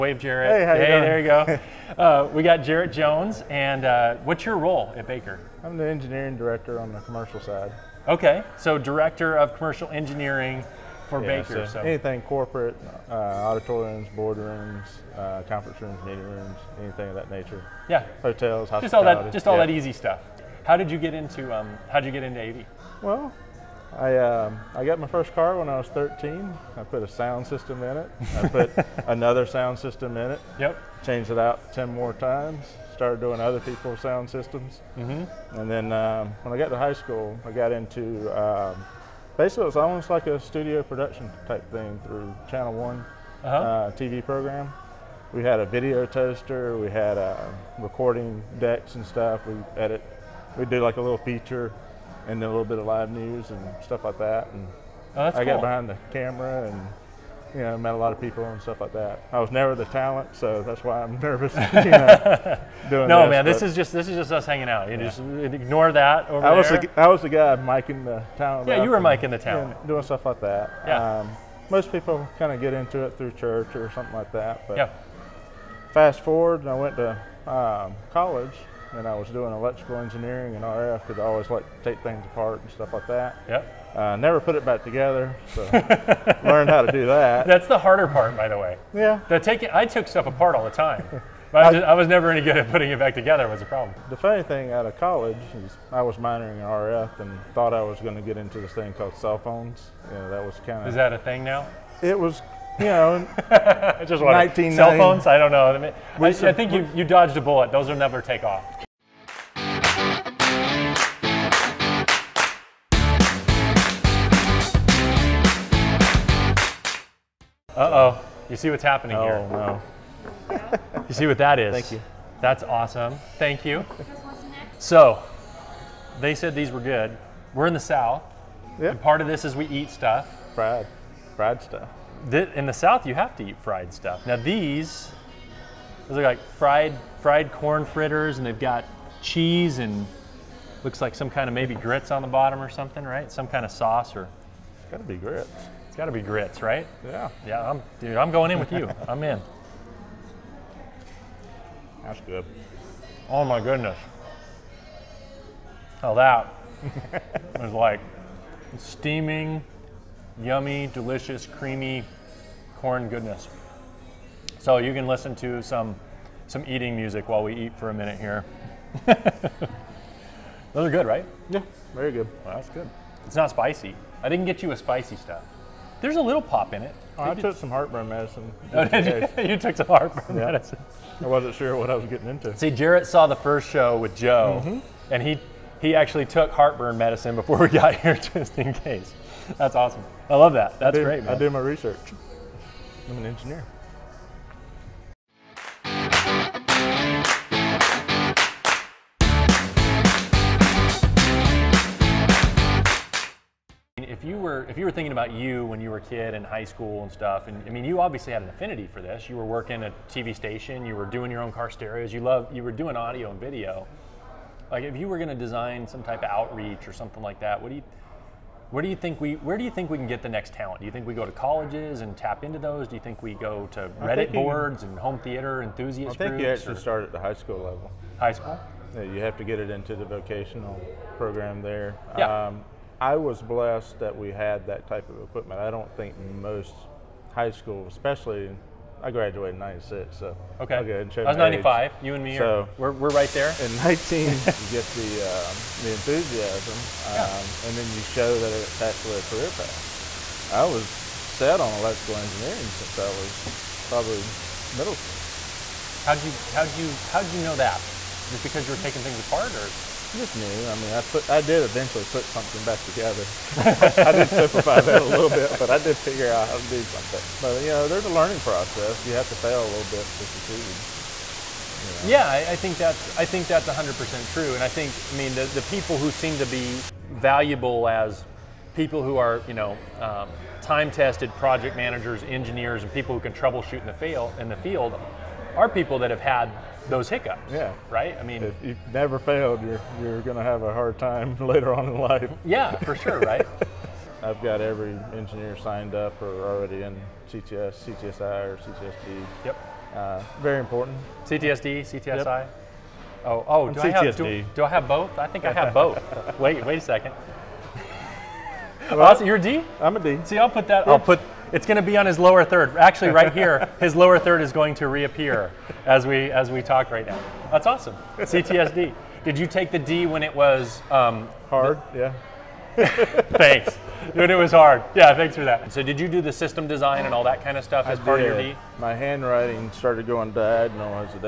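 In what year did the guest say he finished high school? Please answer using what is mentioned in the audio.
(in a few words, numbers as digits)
1996.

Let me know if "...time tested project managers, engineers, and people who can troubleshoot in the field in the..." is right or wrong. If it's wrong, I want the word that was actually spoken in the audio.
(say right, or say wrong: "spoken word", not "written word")
right.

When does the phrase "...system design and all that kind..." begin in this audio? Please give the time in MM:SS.
05:26.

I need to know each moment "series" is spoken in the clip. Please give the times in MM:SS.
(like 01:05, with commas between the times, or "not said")
not said.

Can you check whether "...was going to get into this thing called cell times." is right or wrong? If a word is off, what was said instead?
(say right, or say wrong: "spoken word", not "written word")
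wrong: "phones", not "times".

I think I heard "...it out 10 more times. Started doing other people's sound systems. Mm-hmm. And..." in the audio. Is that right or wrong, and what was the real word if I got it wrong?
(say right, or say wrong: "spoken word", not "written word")
right.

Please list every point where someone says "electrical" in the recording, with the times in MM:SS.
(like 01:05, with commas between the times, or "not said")
01:19, 04:11.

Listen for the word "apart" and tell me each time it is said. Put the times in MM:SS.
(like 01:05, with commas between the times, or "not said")
01:22, 01:30, 04:19.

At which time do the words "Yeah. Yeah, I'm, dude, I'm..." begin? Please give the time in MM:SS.
02:27.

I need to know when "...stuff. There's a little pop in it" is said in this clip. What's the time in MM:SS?
02:55.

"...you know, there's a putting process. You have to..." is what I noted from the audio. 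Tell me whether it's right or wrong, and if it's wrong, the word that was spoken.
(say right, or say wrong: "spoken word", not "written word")
wrong: "learning", not "putting".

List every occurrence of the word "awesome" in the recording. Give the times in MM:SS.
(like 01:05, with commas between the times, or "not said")
02:02, 03:09, 05:17.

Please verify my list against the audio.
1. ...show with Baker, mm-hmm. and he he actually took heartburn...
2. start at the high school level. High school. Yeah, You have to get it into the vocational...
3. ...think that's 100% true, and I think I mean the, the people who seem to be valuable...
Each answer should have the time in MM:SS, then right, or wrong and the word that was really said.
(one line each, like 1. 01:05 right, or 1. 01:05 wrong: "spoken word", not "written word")
1. 03:03 wrong: "Joe", not "Baker"
2. 03:46 right
3. 04:33 right.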